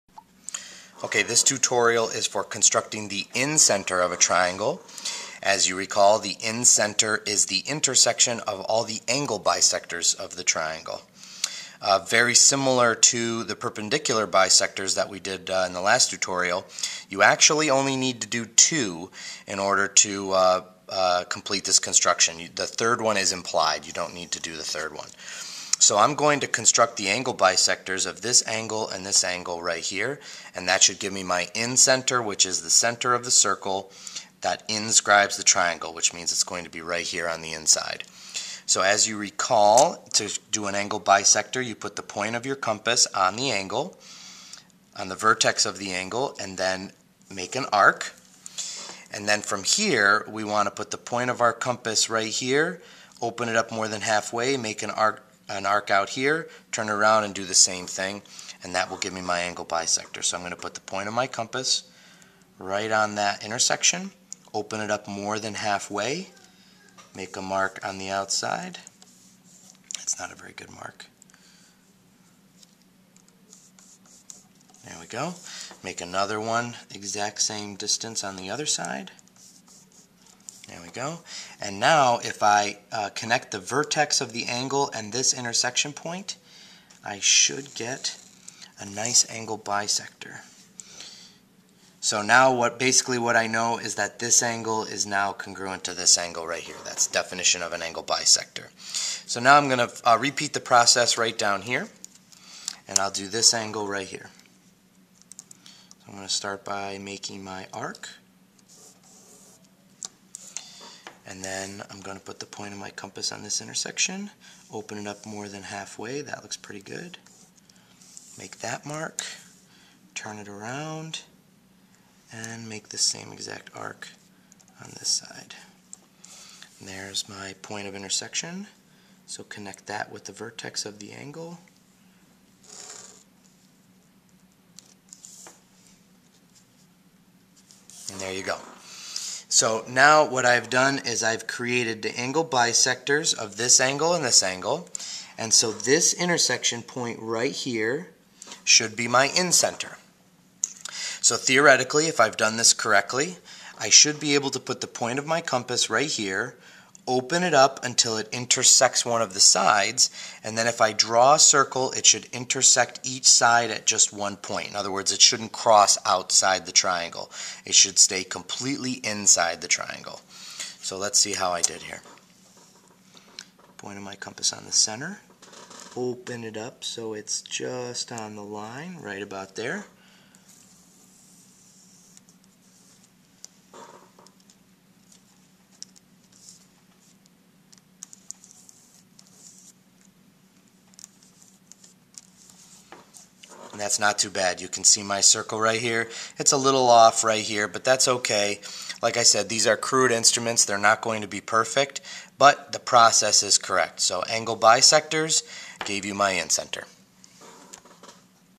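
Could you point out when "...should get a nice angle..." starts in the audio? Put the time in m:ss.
1:27.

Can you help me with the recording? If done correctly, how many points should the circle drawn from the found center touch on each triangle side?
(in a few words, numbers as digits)
1.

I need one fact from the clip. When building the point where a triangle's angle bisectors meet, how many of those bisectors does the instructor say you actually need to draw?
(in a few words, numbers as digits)
2.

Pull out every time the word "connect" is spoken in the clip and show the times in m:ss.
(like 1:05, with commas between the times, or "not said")
1:23, 2:09.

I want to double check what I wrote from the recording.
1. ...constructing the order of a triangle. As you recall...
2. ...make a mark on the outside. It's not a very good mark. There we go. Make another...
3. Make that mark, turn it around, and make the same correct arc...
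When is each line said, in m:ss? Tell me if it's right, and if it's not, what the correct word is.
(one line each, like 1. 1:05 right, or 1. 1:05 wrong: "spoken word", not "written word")
1. 0:02 wrong: "incenter", not "order"
2. 1:07 right
3. 1:58 wrong: "exact", not "correct".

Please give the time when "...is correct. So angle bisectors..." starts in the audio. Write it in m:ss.
3:23.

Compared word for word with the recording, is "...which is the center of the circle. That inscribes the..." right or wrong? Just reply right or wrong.
right.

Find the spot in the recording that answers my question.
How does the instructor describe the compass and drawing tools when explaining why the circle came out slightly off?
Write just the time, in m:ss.
3:19.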